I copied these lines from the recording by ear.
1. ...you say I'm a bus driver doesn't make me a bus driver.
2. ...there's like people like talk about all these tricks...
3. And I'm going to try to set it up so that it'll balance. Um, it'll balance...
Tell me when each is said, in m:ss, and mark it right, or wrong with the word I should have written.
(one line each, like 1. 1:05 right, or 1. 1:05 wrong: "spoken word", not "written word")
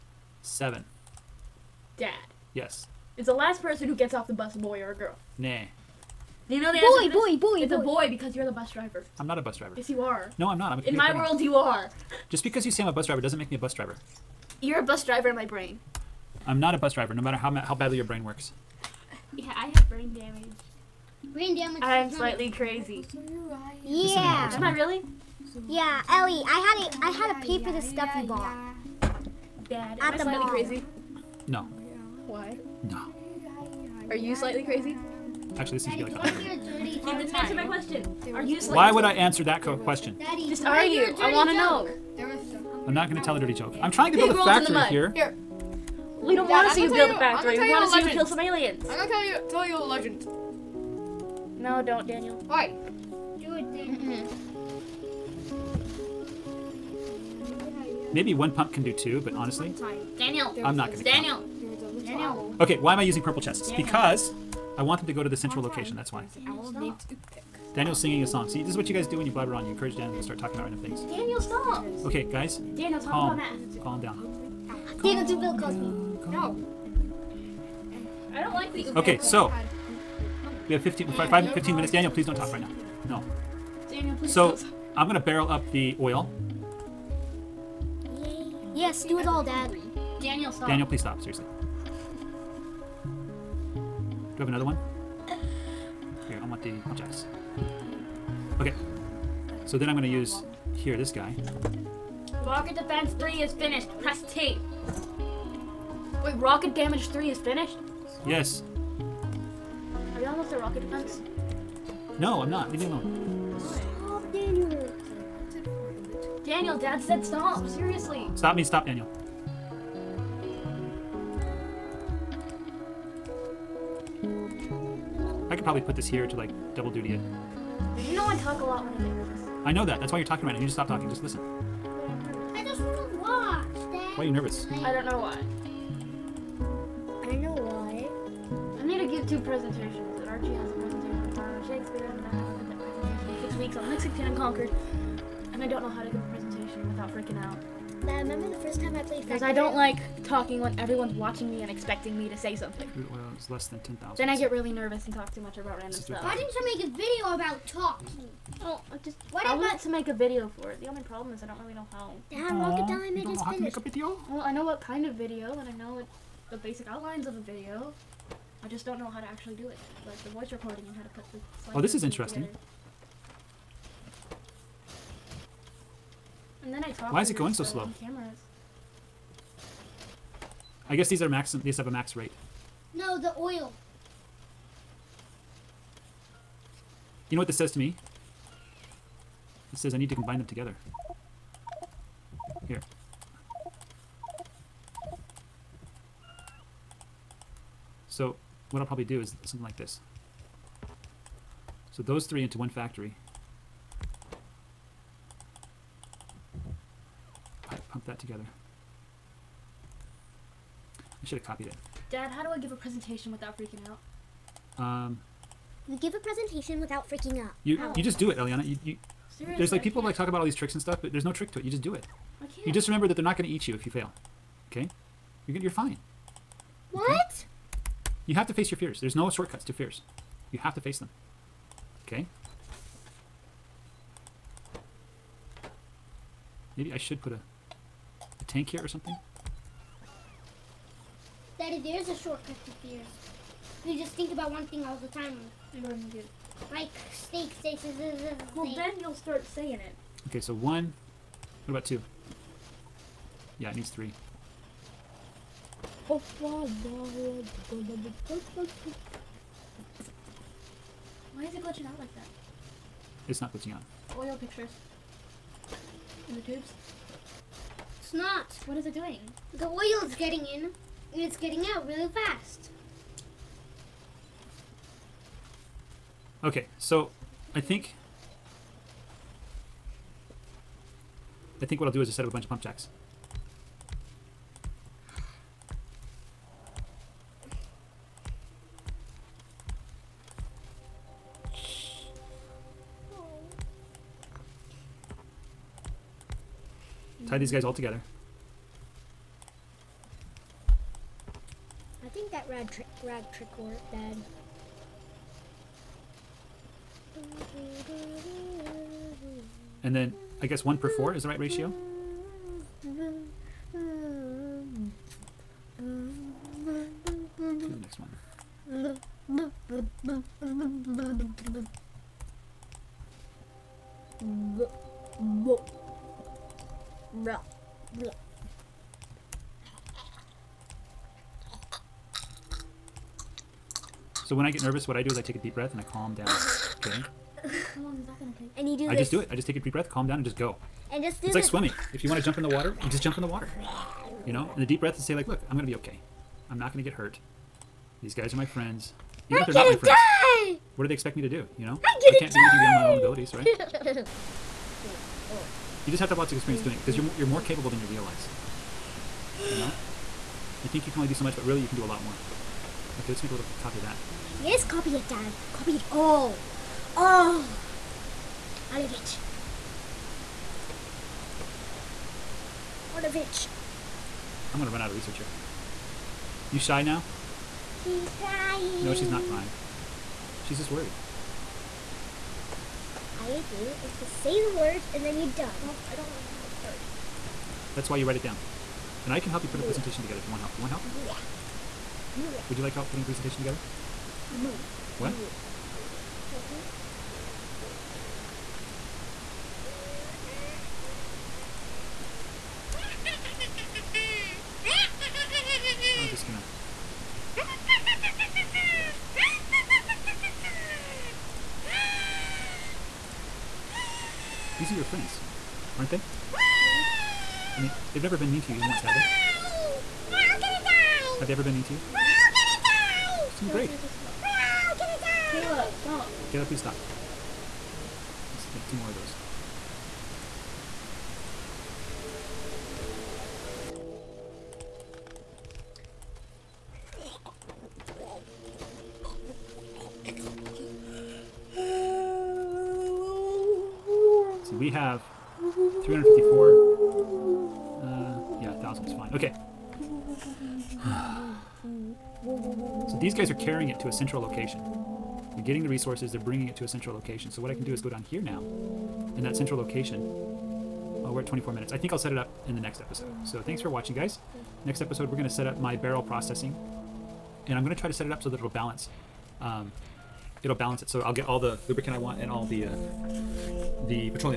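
1. 0:12 right
2. 3:39 right
3. 7:47 right.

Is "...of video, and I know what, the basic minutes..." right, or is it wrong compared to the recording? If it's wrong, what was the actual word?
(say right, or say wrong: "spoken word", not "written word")
wrong: "outlines", not "minutes".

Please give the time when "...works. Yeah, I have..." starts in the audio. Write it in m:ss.
0:18.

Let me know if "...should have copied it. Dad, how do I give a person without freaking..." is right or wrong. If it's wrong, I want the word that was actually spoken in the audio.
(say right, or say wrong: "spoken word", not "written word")
wrong: "presentation", not "person".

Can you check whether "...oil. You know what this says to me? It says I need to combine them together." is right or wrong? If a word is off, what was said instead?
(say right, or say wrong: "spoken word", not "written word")
right.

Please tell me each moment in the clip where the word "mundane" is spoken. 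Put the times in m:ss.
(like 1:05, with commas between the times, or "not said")
not said.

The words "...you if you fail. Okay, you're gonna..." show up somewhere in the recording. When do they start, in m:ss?
3:43.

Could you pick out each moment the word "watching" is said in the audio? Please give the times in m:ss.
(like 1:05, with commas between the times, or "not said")
2:31, 7:43.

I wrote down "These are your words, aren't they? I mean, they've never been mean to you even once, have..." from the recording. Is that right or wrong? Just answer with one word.
wrong.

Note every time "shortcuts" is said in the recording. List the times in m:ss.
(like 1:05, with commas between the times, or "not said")
3:49, 4:02.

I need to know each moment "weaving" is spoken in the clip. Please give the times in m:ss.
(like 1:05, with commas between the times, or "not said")
not said.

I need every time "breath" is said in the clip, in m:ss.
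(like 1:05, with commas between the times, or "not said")
5:35, 5:39, 5:44.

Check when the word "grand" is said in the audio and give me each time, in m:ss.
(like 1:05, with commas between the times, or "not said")
not said.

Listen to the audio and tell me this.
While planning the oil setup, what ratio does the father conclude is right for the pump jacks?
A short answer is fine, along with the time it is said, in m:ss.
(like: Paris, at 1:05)
One per four, at 5:10.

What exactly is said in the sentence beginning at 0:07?
a boy because you're the bus driver.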